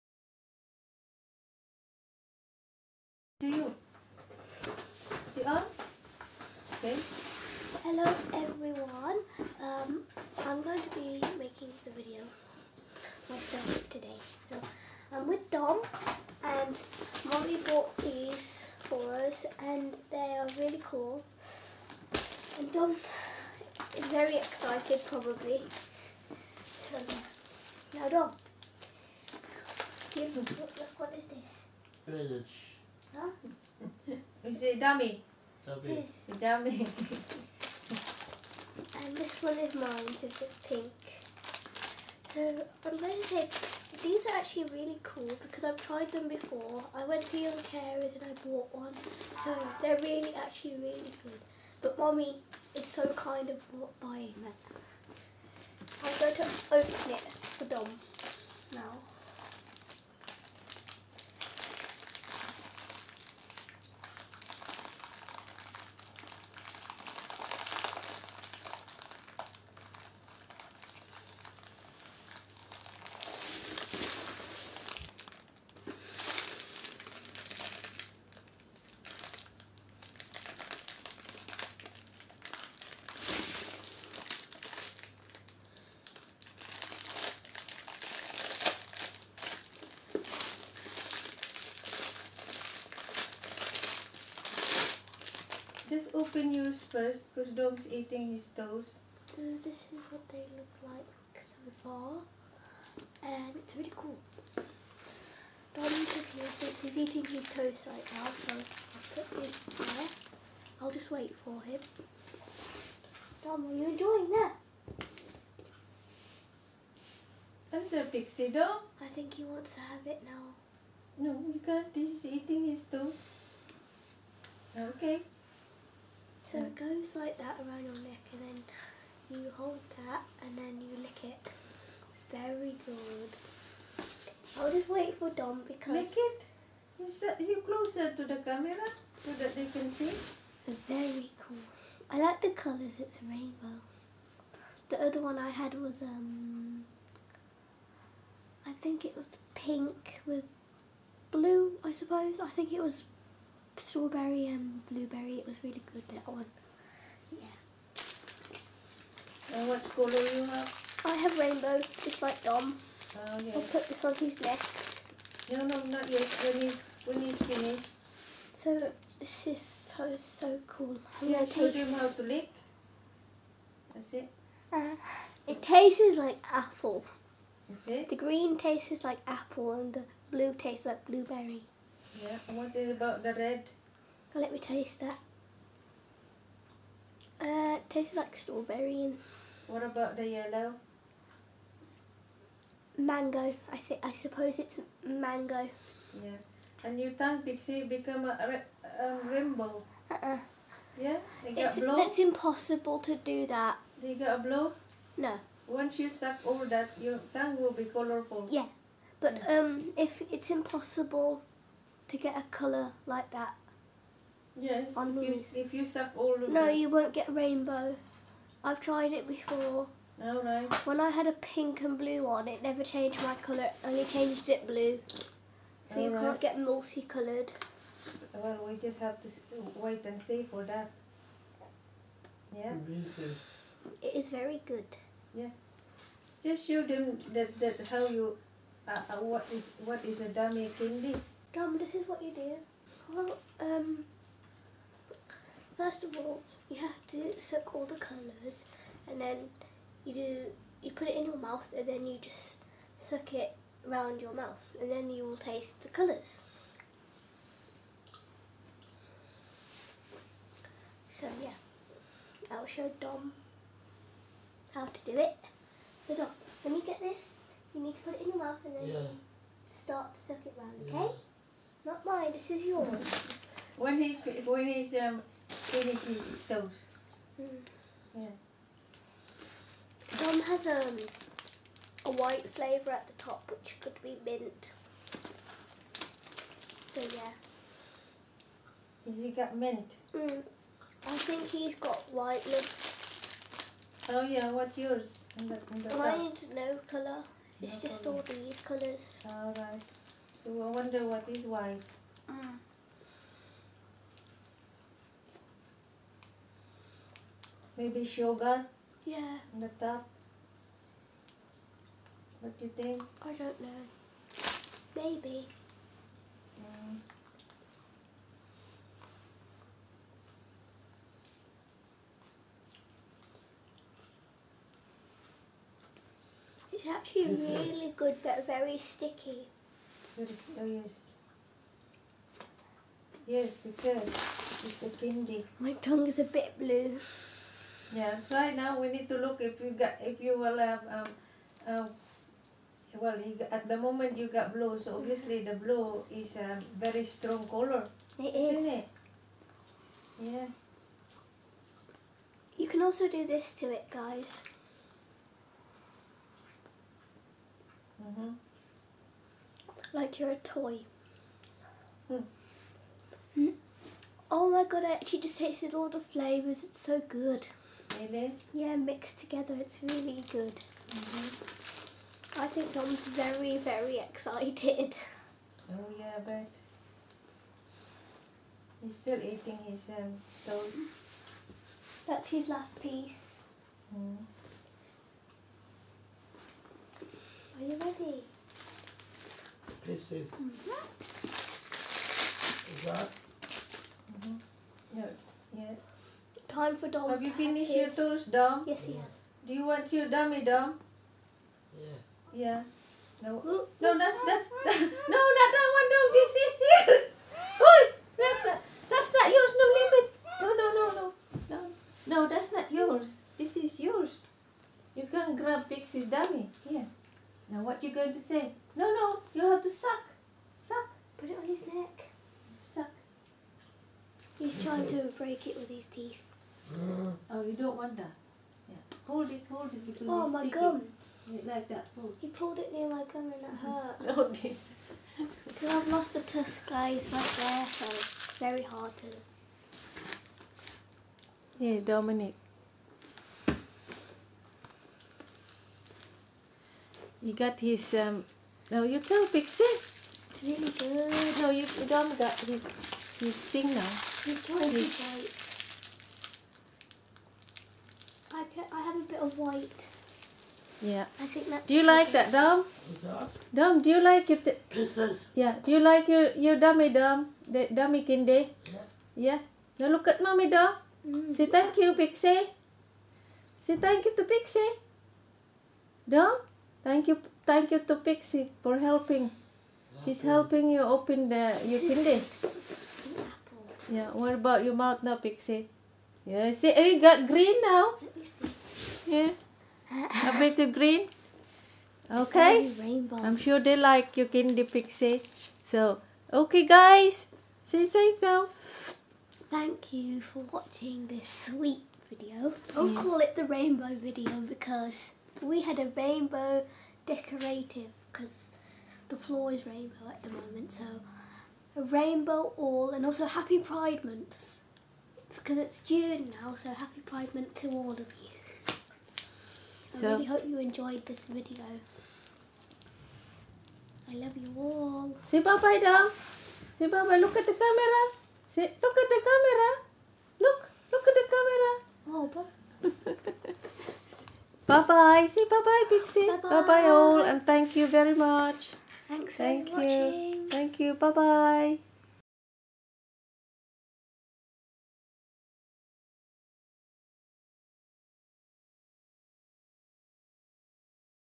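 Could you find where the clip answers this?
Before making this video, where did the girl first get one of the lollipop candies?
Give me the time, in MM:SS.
00:47.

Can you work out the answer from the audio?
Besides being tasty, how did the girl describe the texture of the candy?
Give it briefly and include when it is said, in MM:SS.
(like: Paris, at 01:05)
Very sticky, at 05:28.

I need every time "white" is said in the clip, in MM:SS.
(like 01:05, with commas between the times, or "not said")
04:42, 04:52, 05:01, 07:39.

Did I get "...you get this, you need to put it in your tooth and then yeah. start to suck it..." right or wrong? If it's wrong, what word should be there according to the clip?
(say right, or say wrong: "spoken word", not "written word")
wrong: "mouth", not "tooth".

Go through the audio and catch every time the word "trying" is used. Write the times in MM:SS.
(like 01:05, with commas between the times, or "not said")
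07:04, 07:34.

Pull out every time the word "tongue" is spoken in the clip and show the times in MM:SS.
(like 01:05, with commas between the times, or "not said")
03:27, 05:35.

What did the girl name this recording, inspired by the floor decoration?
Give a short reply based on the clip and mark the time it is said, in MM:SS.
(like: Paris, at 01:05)
The rainbow video, at 08:23.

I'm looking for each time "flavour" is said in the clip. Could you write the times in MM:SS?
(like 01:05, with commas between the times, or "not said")
04:42, 06:05.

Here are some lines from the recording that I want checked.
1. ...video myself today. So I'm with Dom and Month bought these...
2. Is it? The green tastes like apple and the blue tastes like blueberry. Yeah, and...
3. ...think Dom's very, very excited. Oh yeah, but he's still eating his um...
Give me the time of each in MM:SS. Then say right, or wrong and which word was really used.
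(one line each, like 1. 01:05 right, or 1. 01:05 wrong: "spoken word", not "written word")
1. 00:11 wrong: "Molly", not "Month"
2. 02:57 right
3. 06:12 right.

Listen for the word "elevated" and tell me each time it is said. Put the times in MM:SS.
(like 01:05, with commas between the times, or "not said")
not said.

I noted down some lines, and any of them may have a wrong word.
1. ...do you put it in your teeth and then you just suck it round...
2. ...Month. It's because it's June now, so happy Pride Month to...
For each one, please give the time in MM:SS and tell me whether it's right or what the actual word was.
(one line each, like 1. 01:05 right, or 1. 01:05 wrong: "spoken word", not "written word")
1. 04:10 wrong: "mouth", not "teeth"
2. 08:34 right.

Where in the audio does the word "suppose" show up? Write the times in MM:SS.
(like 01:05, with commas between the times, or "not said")
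02:31, 03:14.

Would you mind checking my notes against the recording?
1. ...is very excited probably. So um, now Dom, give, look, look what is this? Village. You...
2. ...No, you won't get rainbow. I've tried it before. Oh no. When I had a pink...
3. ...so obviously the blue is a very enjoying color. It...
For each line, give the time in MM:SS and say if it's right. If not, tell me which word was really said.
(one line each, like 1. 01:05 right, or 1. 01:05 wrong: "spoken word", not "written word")
1. 00:23 right
2. 03:36 right
3. 05:44 wrong: "strong", not "enjoying".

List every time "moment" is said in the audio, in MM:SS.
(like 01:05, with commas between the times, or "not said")
05:43, 08:30.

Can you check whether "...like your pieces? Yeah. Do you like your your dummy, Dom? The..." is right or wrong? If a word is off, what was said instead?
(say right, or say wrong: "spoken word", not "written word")
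right.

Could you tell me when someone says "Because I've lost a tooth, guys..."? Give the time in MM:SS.
07:15.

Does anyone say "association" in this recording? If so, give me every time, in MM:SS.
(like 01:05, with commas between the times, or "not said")
not said.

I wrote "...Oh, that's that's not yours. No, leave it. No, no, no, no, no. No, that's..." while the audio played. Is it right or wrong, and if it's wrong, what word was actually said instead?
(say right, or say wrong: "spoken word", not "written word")
right.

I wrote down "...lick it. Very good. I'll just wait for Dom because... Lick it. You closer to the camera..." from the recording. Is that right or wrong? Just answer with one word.
right.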